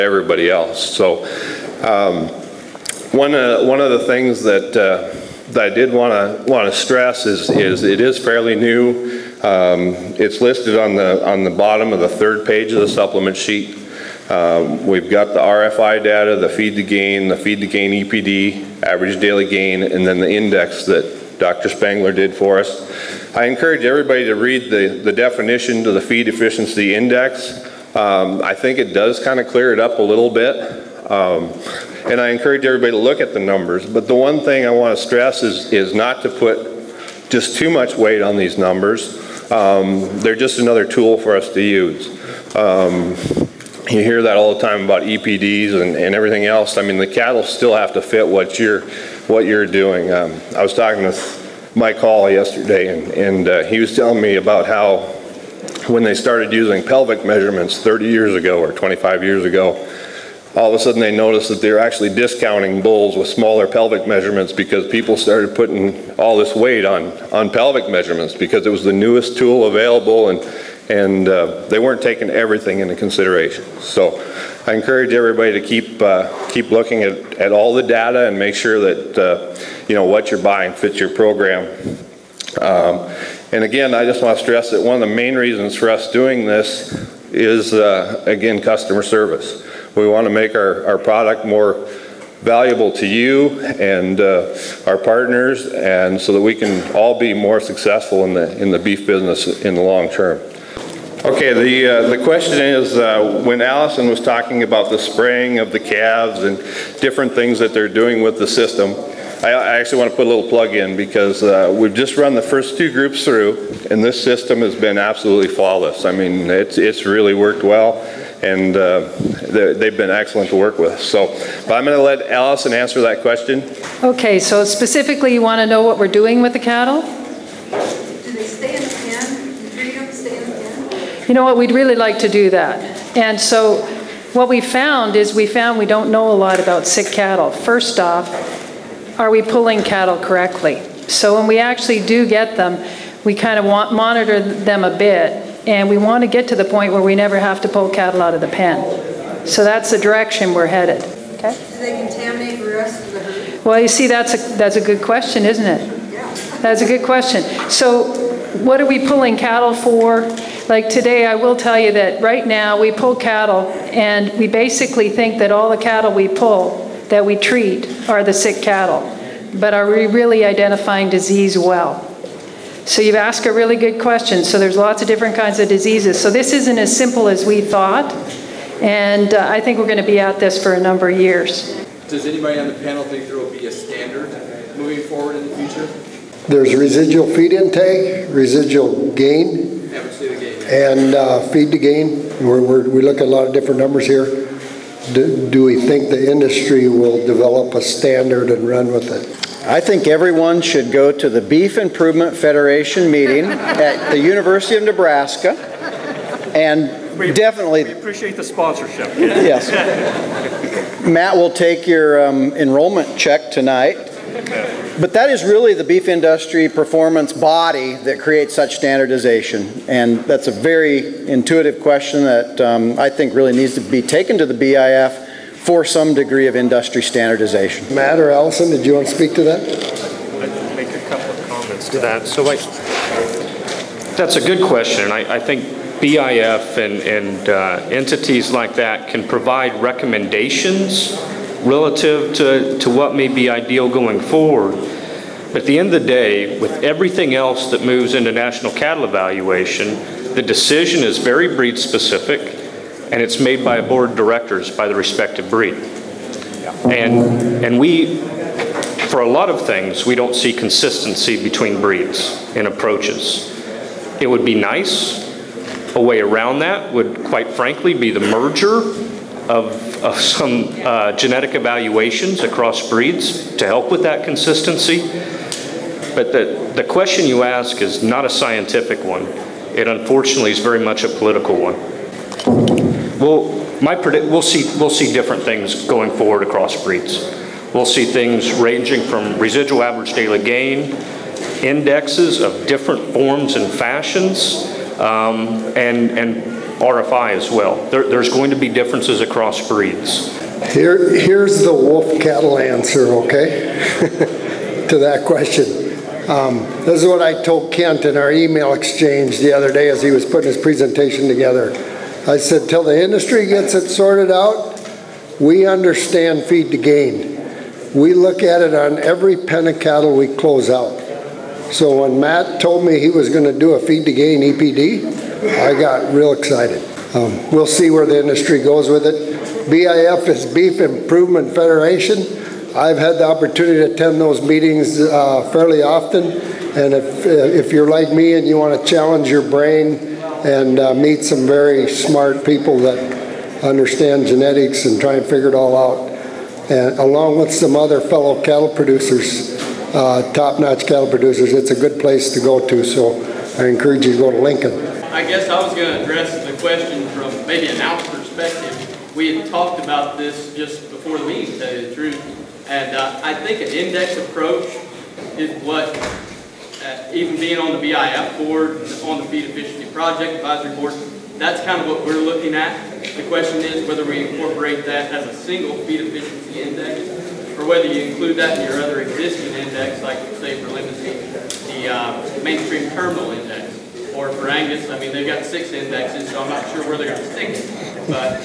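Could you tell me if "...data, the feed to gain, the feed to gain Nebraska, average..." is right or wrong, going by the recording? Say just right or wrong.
wrong.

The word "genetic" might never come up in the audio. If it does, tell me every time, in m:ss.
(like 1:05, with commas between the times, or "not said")
4:31, 5:44.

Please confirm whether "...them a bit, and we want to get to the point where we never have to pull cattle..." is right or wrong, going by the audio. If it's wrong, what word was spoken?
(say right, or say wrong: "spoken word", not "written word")
right.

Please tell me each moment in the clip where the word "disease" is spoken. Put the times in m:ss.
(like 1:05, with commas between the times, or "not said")
2:51, 2:55.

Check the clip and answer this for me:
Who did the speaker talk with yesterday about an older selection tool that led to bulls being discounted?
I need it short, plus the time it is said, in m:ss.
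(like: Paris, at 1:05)
Mike Hall, at 0:51.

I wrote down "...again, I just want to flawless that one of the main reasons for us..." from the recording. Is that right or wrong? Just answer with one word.
wrong.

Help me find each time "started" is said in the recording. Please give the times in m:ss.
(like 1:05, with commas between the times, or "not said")
0:56, 1:05.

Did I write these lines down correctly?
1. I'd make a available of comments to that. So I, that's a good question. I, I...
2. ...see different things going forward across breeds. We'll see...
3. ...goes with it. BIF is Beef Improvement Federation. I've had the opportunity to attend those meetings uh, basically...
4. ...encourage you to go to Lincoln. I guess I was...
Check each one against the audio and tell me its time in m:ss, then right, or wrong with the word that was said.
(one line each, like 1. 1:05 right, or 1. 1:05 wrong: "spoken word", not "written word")
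1. 3:49 wrong: "couple", not "available"
2. 4:44 right
3. 5:28 wrong: "fairly", not "basically"
4. 5:53 right.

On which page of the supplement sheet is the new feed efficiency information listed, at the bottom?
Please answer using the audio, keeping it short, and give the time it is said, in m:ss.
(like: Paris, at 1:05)
third page, at 0:12.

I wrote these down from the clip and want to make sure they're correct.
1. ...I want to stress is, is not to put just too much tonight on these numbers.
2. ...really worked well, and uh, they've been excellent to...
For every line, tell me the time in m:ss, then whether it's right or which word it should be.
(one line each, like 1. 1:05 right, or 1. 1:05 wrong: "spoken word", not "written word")
1. 0:34 wrong: "weight", not "tonight"
2. 1:57 right.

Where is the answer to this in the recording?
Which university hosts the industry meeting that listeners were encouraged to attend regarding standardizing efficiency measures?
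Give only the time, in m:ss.
3:24.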